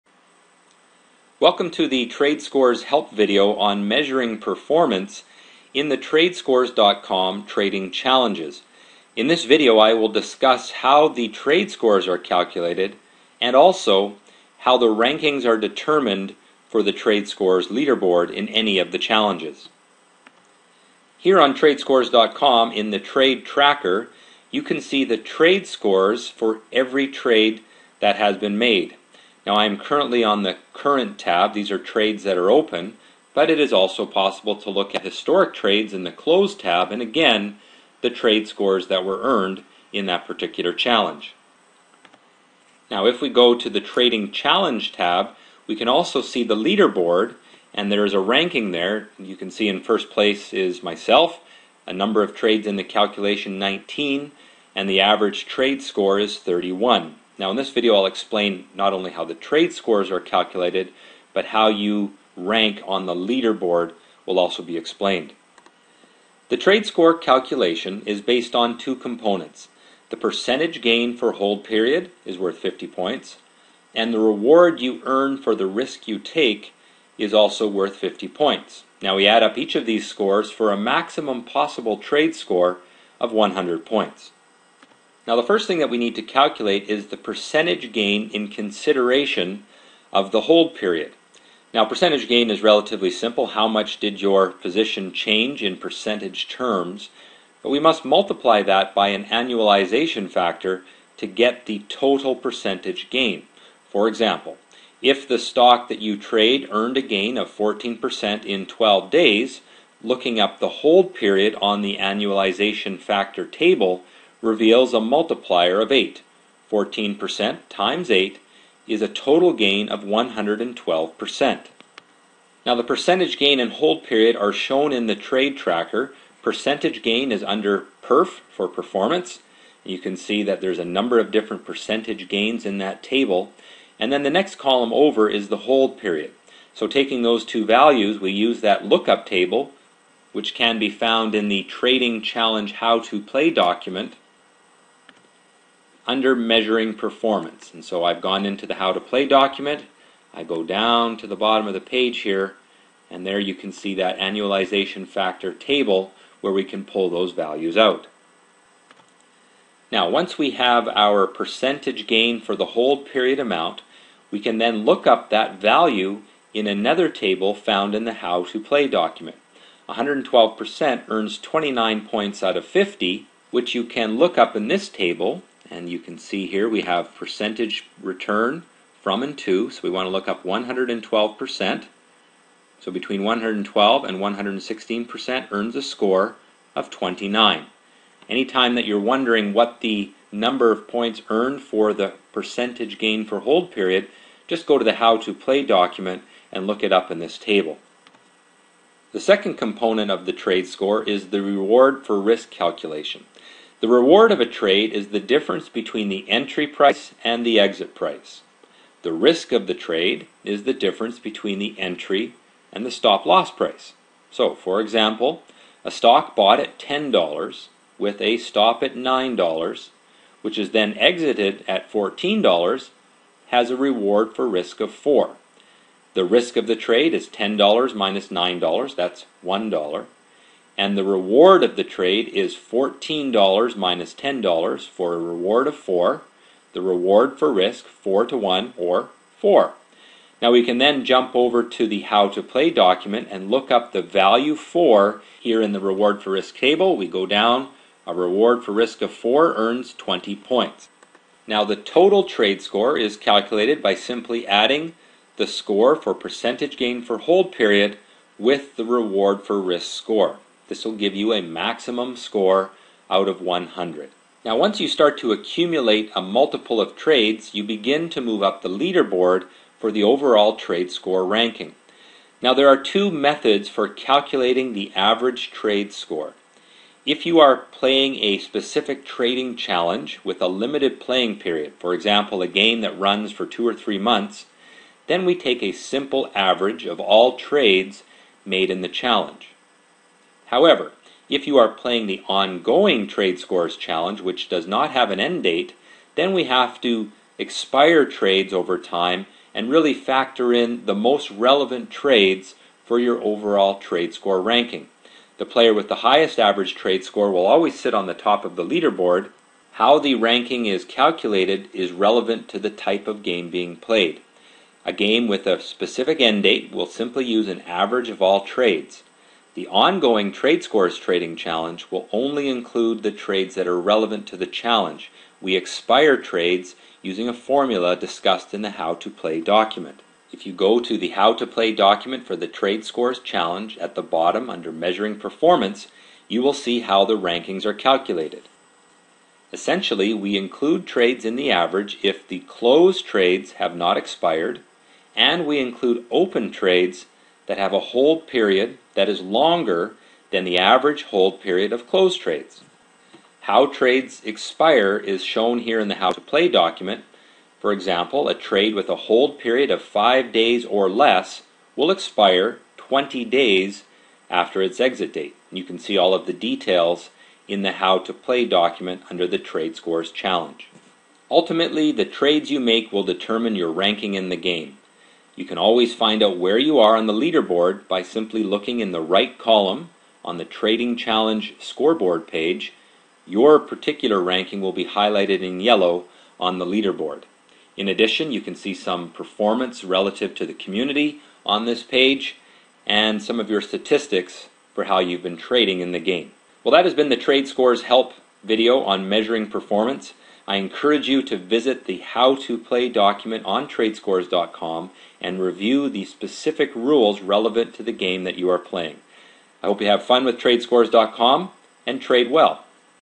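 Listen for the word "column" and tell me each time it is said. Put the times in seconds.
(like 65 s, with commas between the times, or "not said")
134 s, 379 s.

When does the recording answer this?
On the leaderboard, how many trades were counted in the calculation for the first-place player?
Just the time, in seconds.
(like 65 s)
53 s.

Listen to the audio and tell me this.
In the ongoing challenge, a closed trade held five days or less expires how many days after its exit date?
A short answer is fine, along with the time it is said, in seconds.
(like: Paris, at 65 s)
20 days, at 362 s.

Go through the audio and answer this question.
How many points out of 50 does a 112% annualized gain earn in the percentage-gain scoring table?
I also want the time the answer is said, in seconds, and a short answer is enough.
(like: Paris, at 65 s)
29, at 171 s.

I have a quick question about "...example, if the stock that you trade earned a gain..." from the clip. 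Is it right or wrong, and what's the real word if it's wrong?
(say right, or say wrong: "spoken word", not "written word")
right.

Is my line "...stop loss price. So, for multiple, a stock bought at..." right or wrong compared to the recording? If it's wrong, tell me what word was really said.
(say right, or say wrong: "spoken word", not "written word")
wrong: "example", not "multiple".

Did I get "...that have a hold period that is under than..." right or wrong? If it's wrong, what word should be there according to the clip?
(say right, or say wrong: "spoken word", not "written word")
wrong: "longer", not "under".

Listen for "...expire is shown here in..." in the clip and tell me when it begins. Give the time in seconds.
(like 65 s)
354 s.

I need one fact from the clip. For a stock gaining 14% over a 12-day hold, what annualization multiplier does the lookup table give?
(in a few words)
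8.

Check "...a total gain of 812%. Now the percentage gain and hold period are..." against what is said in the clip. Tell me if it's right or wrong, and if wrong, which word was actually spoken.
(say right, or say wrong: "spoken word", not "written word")
wrong: "112", not "812".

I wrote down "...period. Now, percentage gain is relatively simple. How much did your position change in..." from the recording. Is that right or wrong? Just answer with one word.
right.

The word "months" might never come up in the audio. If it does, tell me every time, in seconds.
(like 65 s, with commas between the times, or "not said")
283 s.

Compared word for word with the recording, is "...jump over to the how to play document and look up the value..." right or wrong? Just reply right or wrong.
right.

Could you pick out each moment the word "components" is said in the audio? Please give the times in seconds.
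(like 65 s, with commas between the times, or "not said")
68 s, 199 s.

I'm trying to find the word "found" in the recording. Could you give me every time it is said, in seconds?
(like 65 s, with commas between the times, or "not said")
140 s, 167 s.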